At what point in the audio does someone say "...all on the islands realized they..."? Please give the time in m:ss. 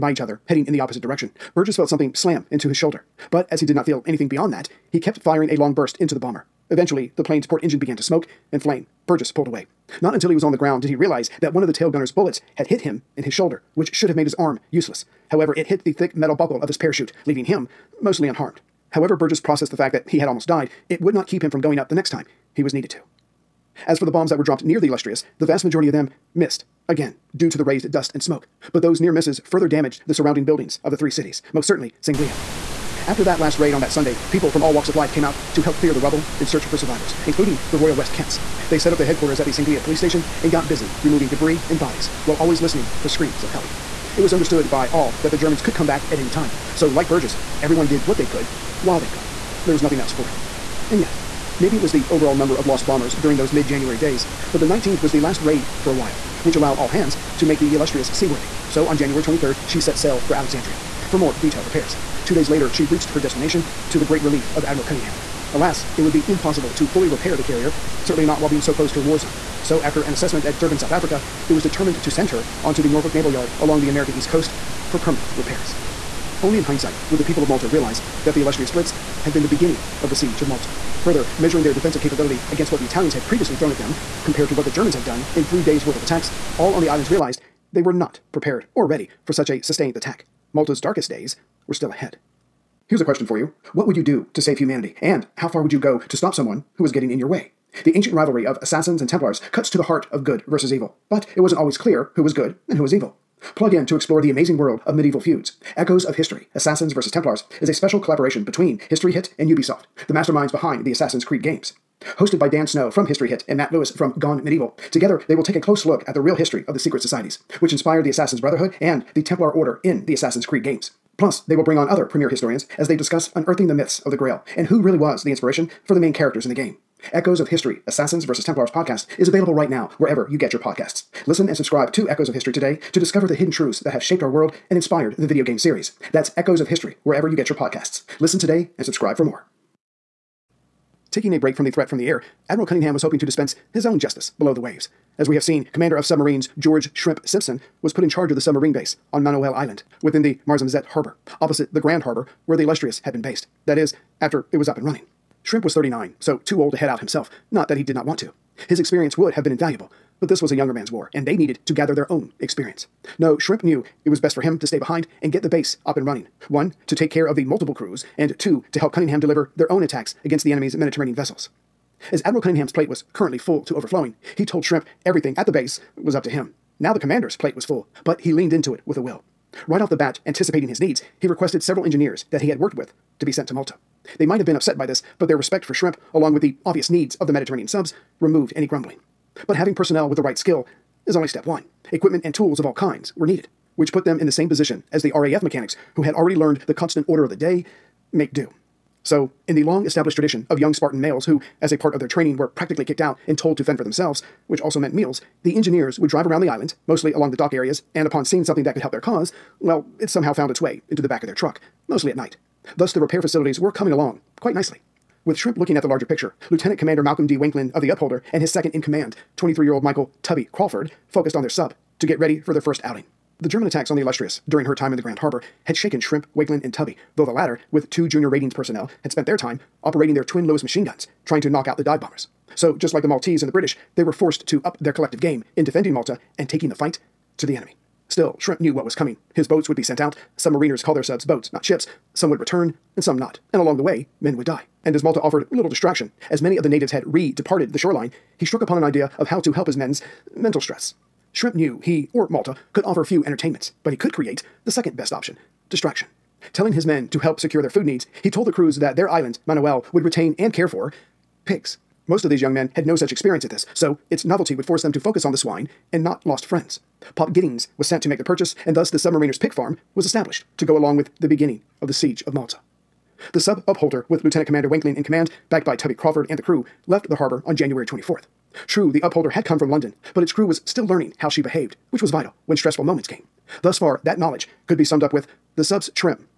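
1:26.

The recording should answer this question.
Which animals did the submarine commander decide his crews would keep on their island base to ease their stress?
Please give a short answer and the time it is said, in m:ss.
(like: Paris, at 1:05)
Pigs, at 4:21.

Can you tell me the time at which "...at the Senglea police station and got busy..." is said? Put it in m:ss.
0:39.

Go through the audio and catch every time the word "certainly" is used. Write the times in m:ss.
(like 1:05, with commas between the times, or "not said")
0:31, 1:08.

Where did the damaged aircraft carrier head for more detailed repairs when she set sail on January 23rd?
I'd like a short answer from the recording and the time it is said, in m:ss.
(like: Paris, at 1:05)
Alexandria, at 1:00.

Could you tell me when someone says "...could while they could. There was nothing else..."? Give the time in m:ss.
0:48.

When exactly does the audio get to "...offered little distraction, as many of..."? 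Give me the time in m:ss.
4:05.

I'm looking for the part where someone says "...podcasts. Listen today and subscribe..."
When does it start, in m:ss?
2:17.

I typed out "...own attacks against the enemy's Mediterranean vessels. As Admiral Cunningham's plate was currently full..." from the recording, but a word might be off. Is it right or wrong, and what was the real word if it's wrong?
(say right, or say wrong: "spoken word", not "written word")
right.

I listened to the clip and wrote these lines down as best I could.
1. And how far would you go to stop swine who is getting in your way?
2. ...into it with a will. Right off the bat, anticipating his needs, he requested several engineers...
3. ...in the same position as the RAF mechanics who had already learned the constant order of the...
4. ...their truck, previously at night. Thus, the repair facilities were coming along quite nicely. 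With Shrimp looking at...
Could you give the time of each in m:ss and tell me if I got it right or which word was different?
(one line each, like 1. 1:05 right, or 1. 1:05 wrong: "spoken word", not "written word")
1. 1:35 wrong: "someone", not "swine"
2. 2:58 right
3. 3:14 right
4. 3:31 wrong: "mostly", not "previously".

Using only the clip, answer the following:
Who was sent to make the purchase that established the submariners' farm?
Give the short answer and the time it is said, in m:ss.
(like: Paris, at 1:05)
Pop Giddings, at 4:27.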